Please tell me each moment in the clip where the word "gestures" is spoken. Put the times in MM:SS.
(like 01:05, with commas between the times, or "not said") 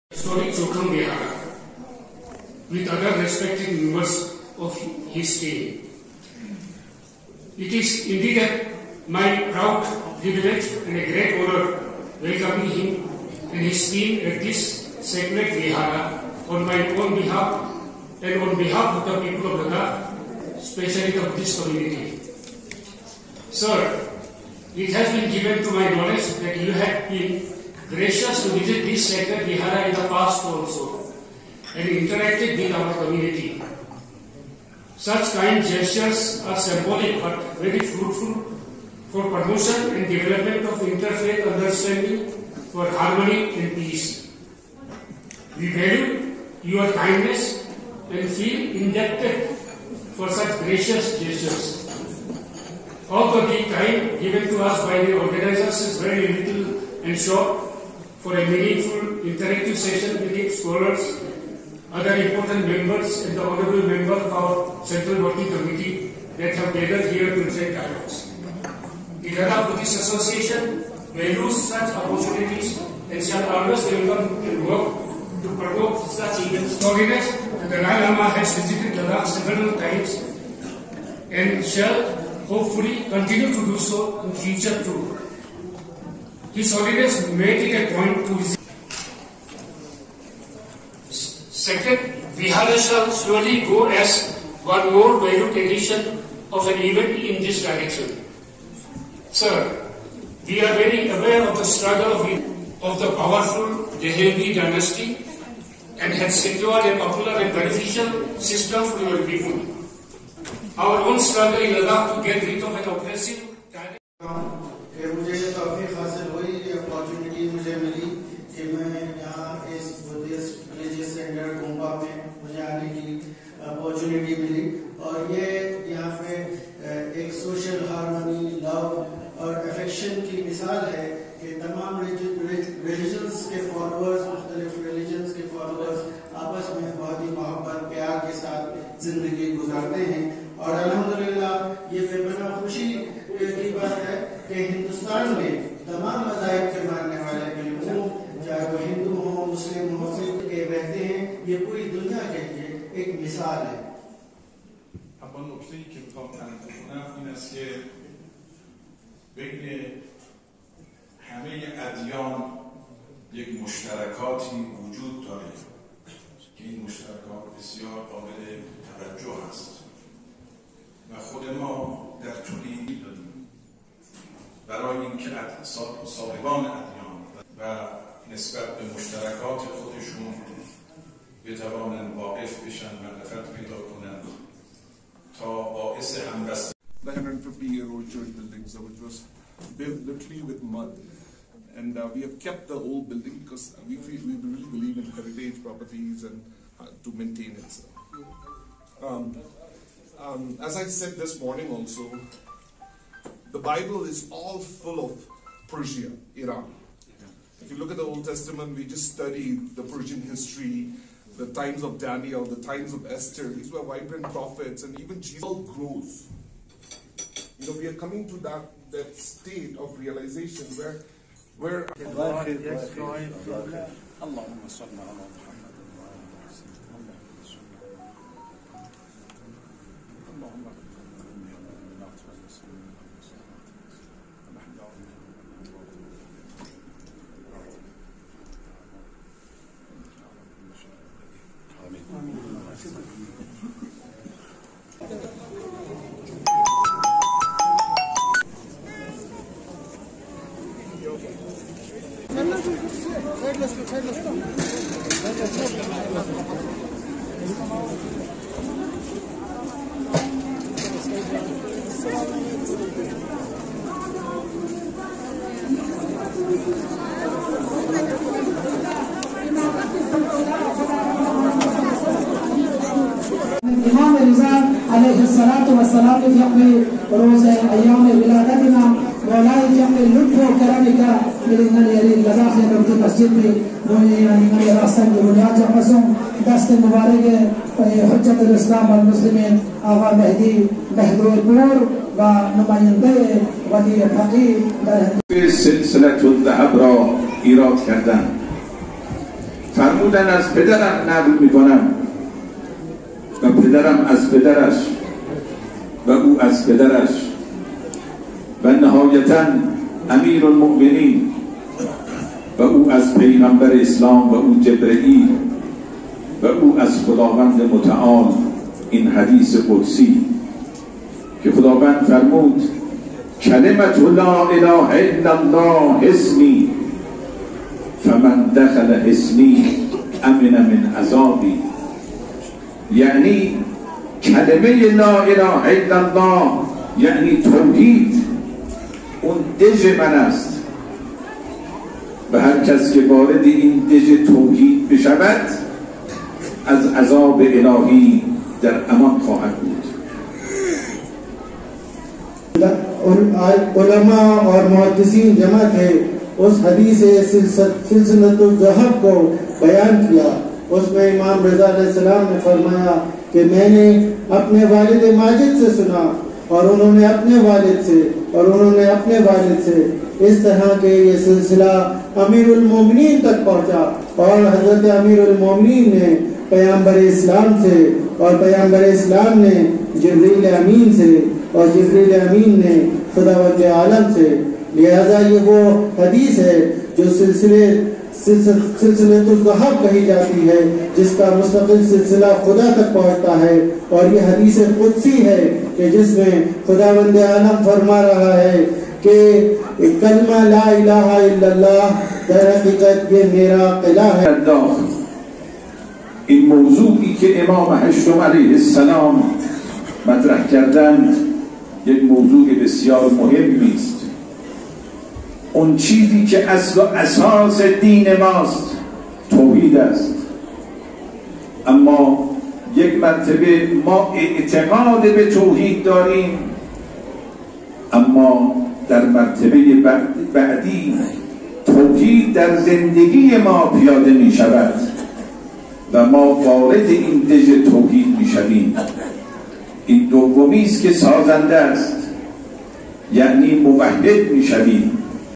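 00:35, 00:51.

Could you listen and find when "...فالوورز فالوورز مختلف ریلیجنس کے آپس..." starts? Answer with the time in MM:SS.
02:13.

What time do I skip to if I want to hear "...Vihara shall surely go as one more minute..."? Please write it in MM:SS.
01:32.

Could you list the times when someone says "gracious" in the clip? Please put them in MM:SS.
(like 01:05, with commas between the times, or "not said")
00:27, 00:50.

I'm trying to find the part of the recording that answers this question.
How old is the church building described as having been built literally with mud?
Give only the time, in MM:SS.
03:07.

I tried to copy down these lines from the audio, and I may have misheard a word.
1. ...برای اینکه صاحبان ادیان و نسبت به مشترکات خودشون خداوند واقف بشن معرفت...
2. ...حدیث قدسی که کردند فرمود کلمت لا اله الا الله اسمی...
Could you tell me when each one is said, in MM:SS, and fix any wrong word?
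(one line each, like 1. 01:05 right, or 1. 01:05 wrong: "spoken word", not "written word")
1. 02:54 wrong: "بتوانند", not "خداوند"
2. 05:19 wrong: "خداوند", not "کردند".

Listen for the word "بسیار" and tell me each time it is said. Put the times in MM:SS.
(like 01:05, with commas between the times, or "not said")
02:47, 06:52.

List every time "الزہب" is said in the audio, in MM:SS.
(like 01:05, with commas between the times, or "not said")
05:58.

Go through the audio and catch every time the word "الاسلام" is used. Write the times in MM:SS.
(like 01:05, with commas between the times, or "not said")
04:48.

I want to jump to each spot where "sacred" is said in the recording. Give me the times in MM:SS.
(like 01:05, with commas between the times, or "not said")
00:15, 00:29.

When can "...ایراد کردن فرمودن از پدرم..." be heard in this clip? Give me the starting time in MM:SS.
04:57.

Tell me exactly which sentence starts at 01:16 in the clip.
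Storiness, the Dalai Lama has visited Ghana several times and shall hopefully continue to do so in future too.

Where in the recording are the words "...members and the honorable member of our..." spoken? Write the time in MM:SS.
01:02.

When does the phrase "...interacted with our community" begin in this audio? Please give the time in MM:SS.
00:31.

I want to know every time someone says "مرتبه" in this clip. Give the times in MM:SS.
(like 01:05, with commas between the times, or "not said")
07:02, 07:09.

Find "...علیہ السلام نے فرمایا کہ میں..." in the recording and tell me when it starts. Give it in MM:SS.
06:01.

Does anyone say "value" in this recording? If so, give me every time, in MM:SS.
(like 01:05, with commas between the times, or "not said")
00:45, 01:11.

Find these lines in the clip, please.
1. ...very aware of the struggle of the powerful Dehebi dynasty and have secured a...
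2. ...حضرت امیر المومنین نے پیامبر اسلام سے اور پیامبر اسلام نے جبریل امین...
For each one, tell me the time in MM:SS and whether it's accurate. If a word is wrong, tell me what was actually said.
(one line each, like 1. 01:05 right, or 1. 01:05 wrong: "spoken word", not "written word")
1. 01:40 right
2. 06:14 right.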